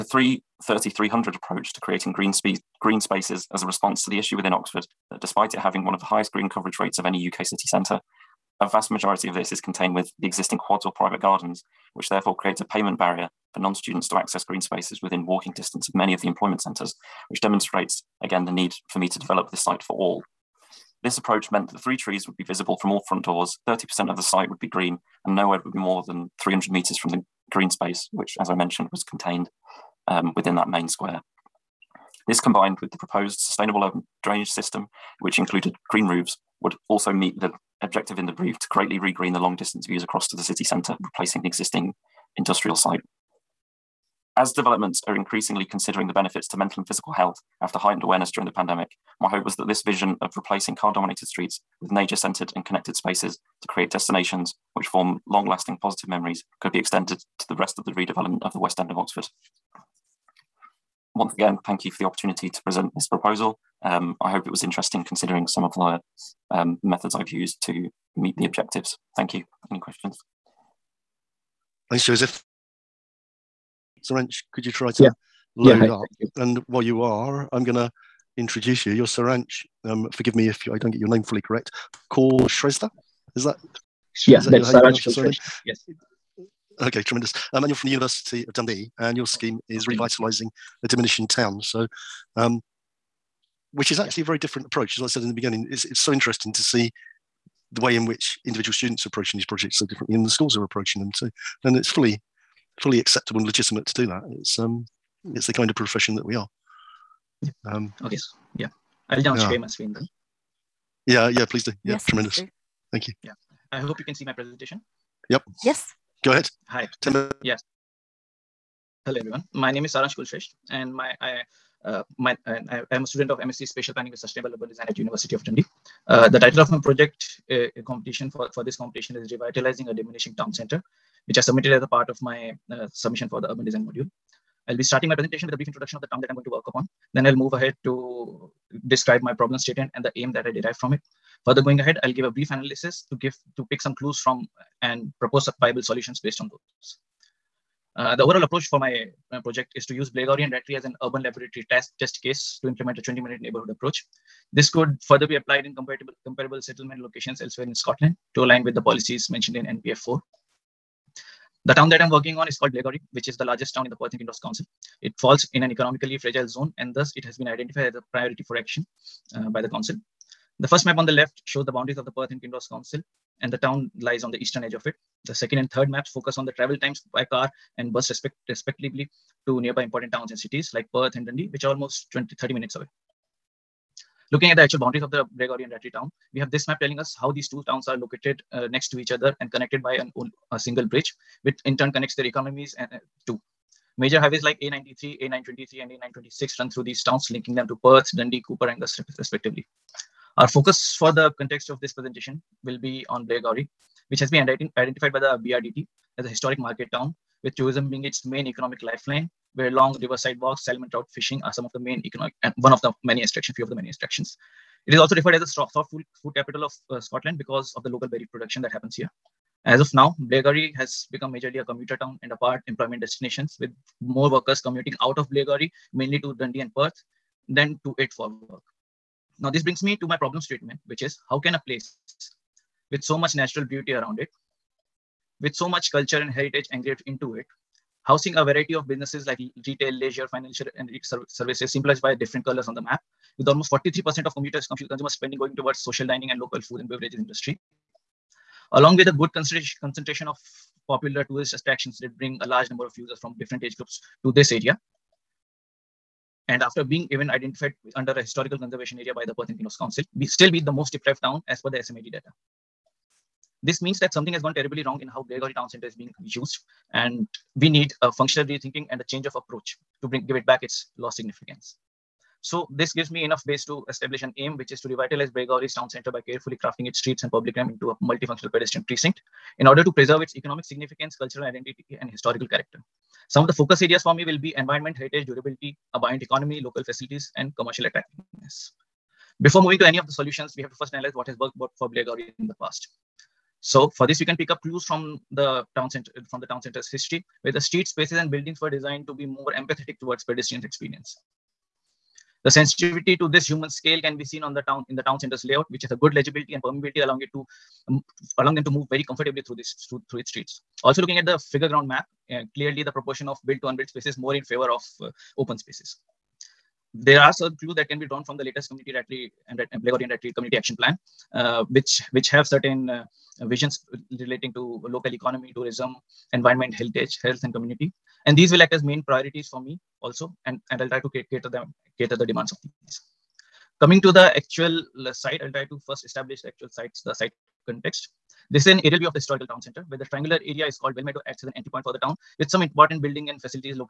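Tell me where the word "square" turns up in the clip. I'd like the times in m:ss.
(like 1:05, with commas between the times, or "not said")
0:30.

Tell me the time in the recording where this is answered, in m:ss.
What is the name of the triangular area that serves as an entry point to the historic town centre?
5:40.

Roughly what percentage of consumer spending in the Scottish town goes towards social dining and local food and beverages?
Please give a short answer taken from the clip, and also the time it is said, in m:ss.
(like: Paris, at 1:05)
43%, at 4:03.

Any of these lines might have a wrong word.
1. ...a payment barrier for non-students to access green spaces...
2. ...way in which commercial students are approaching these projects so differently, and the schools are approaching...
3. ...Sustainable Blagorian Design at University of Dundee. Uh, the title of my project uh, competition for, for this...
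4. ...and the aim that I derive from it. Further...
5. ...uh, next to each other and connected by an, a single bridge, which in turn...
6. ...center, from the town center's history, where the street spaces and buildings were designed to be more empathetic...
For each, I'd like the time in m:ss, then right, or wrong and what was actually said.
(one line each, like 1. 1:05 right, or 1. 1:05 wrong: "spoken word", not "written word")
1. 0:12 right
2. 1:37 wrong: "individual", not "commercial"
3. 2:04 wrong: "Urban", not "Blagorian"
4. 2:19 right
5. 3:08 right
6. 4:55 right.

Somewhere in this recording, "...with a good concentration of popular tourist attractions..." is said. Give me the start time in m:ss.
4:08.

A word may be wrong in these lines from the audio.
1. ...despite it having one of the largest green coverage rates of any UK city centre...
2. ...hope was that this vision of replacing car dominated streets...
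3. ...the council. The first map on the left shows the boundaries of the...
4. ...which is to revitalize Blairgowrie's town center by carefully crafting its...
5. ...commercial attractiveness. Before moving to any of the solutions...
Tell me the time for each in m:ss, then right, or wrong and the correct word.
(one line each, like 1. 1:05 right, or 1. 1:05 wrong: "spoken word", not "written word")
1. 0:05 wrong: "highest", not "largest"
2. 0:49 right
3. 2:49 right
4. 4:34 right
5. 4:47 right.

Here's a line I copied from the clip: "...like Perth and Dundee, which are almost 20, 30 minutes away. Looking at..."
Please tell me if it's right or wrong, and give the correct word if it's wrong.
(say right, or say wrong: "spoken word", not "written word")
right.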